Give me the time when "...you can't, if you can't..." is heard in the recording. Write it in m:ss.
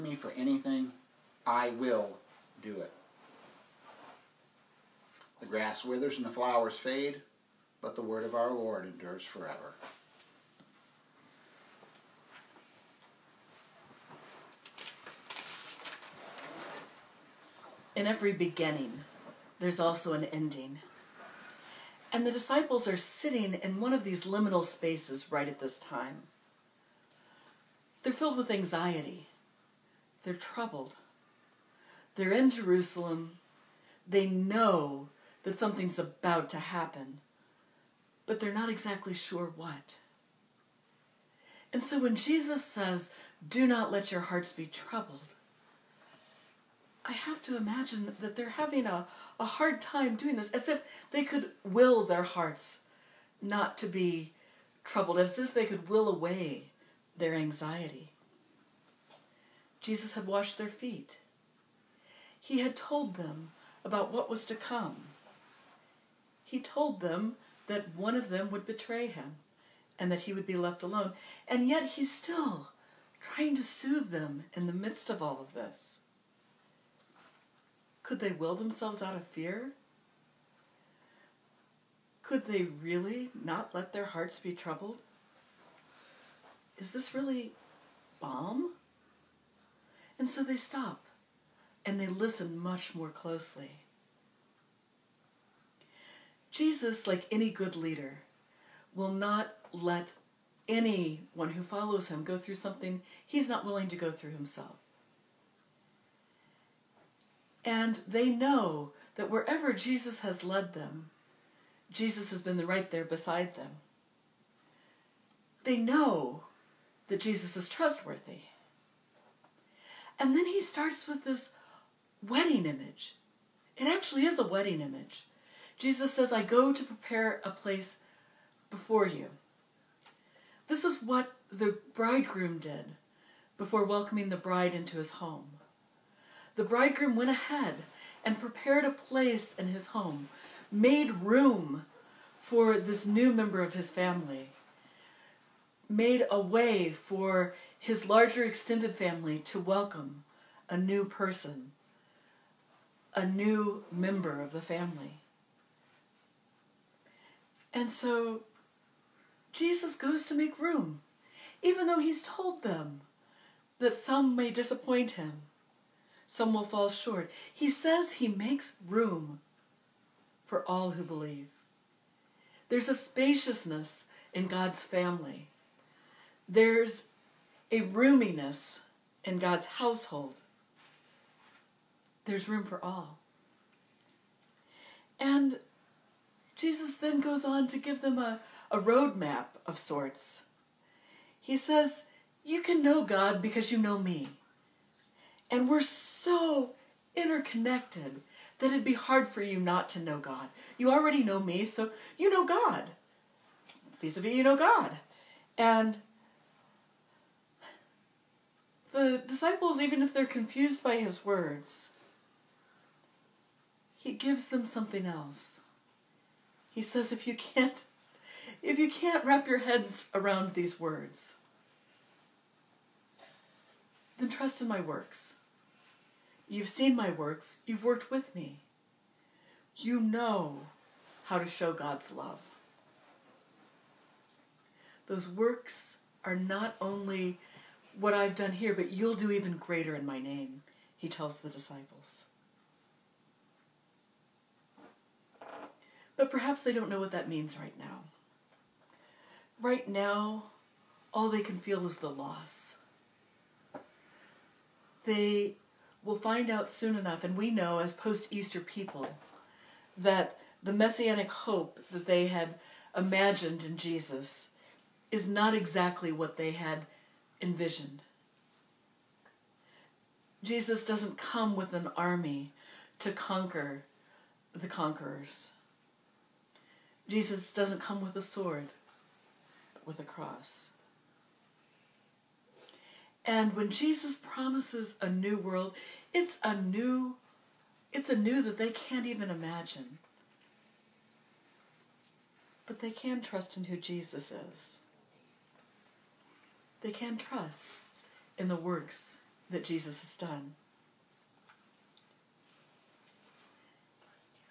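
3:37.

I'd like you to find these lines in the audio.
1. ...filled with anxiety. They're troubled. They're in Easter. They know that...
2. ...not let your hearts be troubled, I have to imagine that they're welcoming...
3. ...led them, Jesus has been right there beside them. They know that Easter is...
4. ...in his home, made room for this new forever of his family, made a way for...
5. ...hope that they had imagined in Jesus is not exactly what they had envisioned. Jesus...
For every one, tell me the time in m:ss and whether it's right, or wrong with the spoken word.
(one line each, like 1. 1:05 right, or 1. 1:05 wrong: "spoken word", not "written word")
1. 0:28 wrong: "Jerusalem", not "Easter"
2. 0:43 wrong: "having", not "welcoming"
3. 1:50 wrong: "Jesus", not "Easter"
4. 2:19 wrong: "member", not "forever"
5. 4:21 right.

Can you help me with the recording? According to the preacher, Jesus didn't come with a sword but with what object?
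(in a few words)
A cross.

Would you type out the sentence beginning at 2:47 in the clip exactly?
He says he makes room for all who believe.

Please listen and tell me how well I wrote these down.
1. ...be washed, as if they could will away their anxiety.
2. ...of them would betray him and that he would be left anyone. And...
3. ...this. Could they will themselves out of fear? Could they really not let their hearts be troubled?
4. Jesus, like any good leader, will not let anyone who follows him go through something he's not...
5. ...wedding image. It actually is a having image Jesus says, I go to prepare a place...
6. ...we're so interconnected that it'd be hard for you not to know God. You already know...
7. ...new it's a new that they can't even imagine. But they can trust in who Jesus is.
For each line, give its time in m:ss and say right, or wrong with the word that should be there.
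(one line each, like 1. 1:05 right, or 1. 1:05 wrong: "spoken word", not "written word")
1. 0:53 wrong: "troubled", not "washed"
2. 1:08 wrong: "alone", not "anyone"
3. 1:15 right
4. 1:36 right
5. 2:02 wrong: "wedding", not "having"
6. 3:15 right
7. 4:46 right.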